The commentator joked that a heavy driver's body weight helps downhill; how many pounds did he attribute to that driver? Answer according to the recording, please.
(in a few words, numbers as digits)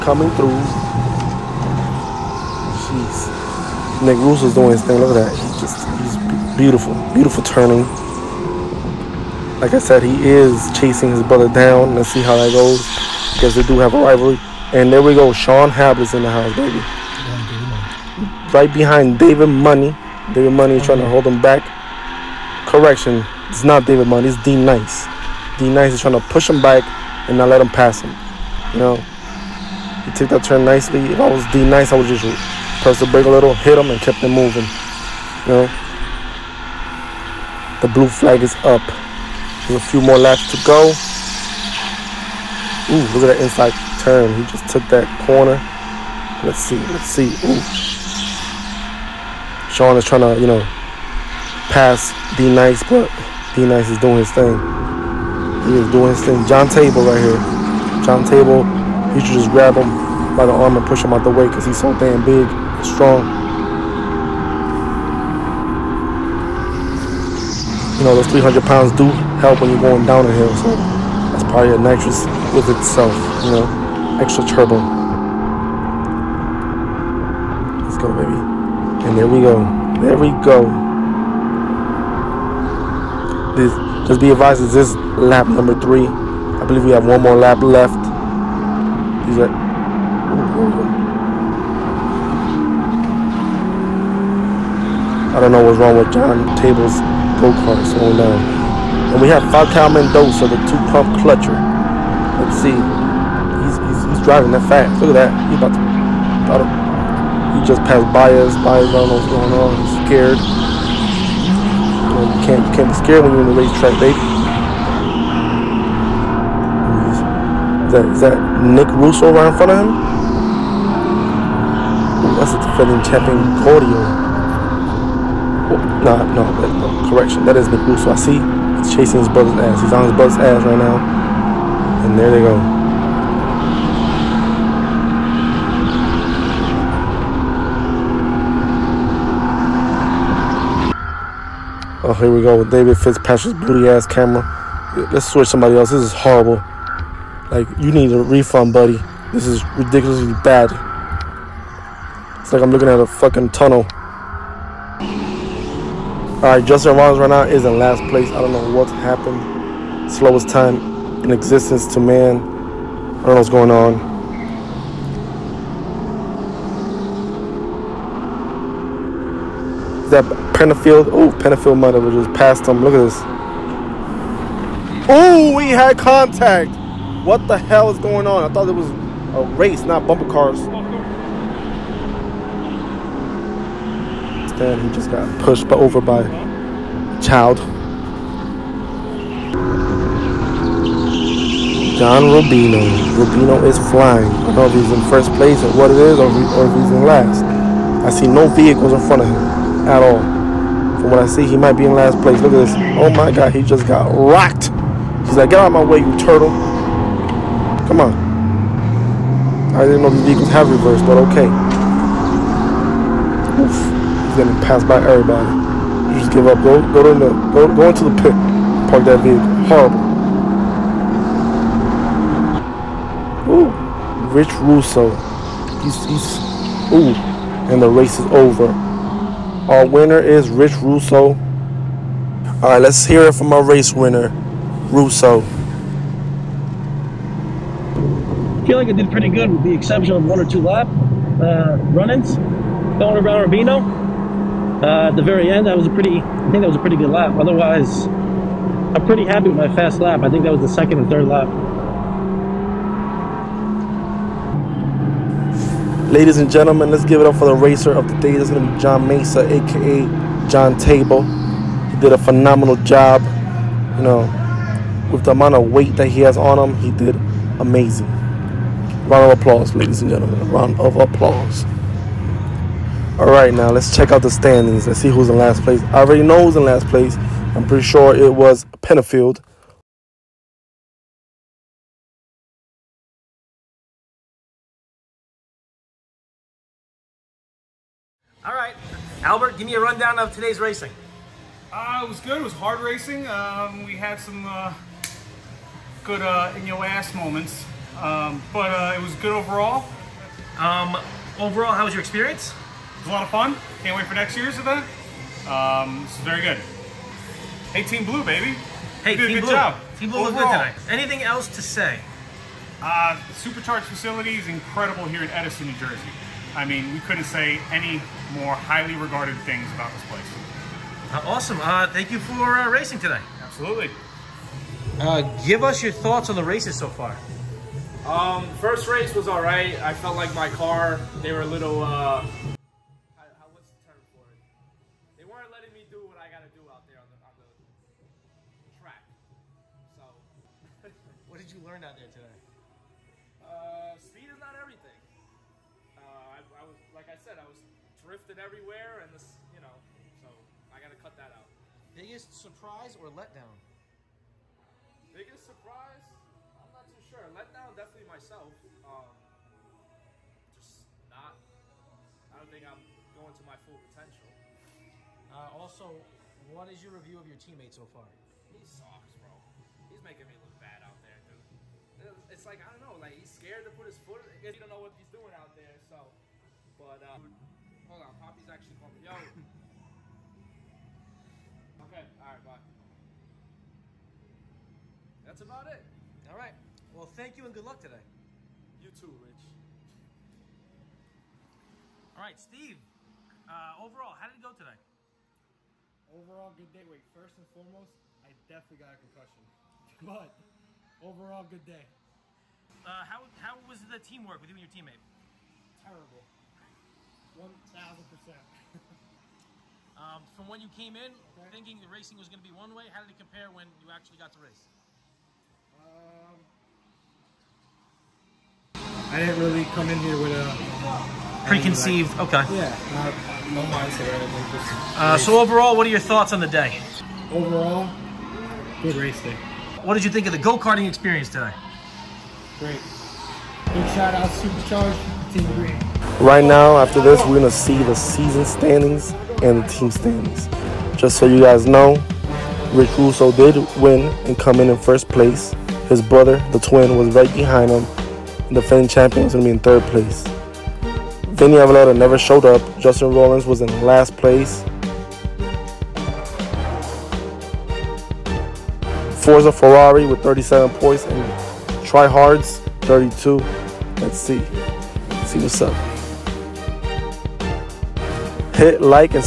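300.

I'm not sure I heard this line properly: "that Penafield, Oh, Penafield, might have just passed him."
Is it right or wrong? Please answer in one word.
right.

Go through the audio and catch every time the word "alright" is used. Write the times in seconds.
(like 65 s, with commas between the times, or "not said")
156 s, 382 s.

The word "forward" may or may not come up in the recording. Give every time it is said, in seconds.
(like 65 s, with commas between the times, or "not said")
not said.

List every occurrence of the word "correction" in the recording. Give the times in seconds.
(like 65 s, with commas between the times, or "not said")
22 s, 127 s.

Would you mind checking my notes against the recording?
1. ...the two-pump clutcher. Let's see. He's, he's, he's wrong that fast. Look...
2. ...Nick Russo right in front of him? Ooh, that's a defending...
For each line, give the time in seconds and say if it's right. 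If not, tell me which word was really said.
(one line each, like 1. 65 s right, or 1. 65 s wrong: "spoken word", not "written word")
1. 100 s wrong: "driving", not "wrong"
2. 118 s right.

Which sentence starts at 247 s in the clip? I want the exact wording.
Otherwise, I'm pretty happy with my fast lap.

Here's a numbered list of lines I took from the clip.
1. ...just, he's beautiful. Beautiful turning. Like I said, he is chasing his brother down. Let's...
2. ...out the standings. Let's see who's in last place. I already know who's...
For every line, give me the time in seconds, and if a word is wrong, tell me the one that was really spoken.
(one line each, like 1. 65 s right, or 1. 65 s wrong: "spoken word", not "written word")
1. 5 s right
2. 274 s right.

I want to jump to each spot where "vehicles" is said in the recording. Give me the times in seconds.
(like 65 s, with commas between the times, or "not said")
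198 s, 210 s, 219 s.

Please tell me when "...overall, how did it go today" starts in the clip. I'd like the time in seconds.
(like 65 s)
393 s.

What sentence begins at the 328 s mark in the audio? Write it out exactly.
Um, first race was all right.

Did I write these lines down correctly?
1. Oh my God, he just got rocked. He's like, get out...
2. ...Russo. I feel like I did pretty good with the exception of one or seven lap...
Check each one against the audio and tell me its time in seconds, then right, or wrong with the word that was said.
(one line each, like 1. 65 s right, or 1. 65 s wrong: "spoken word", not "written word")
1. 202 s right
2. 234 s wrong: "two", not "seven".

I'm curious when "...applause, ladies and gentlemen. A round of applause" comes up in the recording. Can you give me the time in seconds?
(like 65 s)
269 s.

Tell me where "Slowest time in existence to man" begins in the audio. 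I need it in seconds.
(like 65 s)
160 s.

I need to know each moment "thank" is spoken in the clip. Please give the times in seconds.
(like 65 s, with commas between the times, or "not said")
321 s, 387 s.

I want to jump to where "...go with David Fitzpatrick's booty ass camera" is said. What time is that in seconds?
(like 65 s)
142 s.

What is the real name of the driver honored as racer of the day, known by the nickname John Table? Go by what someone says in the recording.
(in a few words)
John Mesa.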